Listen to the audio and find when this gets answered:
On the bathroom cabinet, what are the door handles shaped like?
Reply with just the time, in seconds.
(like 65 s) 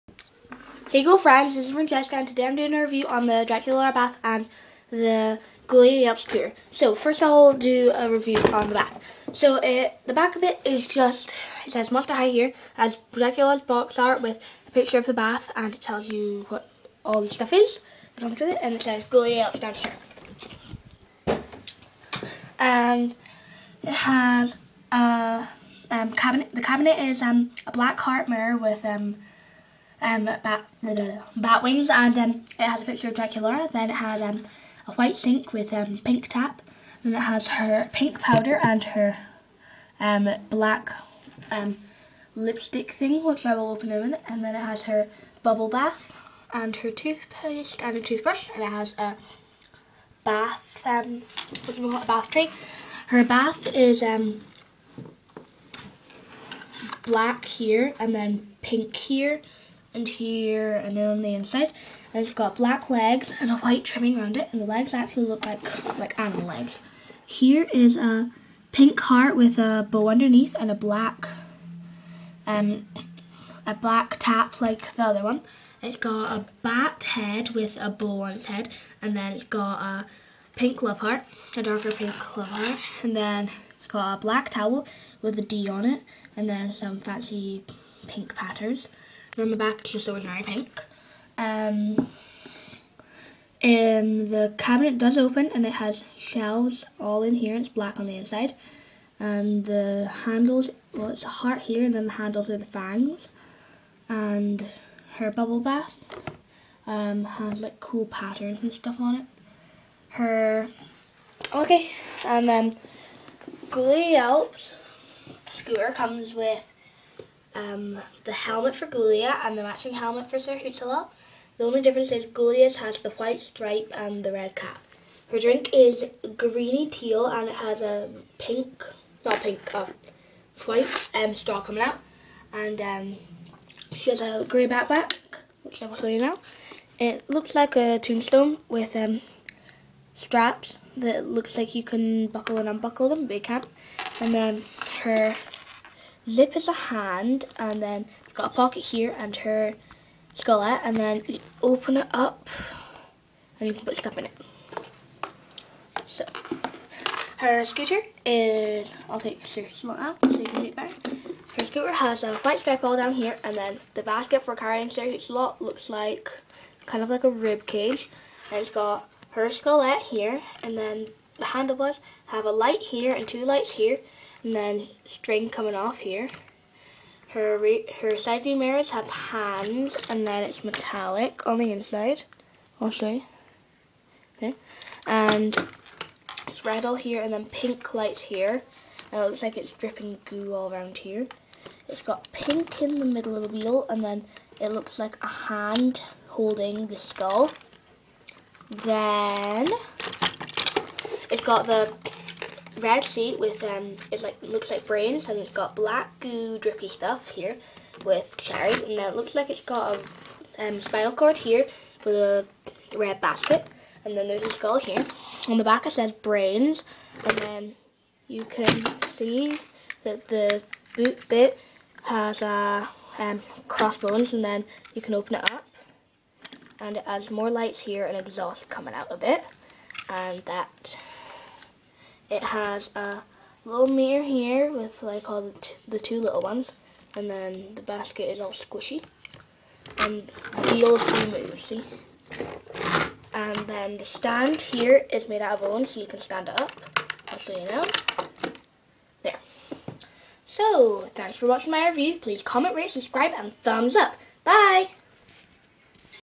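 102 s.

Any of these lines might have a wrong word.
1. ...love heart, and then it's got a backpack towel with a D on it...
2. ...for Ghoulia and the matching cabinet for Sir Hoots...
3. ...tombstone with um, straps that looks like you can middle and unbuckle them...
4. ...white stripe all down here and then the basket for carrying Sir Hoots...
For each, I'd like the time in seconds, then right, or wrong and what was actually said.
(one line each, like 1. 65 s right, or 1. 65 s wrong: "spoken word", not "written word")
1. 82 s wrong: "black", not "backpack"
2. 118 s wrong: "helmet", not "cabinet"
3. 137 s wrong: "buckle", not "middle"
4. 162 s right.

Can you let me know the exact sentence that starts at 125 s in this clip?
Her drink is greeny teal and it has a pink, not pink, uh, white um, straw coming out.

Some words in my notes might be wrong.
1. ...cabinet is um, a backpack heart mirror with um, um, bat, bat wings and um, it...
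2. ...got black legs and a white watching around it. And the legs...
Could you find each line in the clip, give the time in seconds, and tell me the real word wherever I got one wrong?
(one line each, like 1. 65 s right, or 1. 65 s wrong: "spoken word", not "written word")
1. 26 s wrong: "black", not "backpack"
2. 62 s wrong: "trimming", not "watching".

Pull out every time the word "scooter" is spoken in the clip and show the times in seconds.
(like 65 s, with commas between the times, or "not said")
115 s, 157 s, 161 s.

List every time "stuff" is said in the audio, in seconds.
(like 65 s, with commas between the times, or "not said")
17 s, 108 s, 153 s, 206 s.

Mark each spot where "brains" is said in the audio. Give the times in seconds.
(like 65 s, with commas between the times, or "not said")
204 s, 216 s.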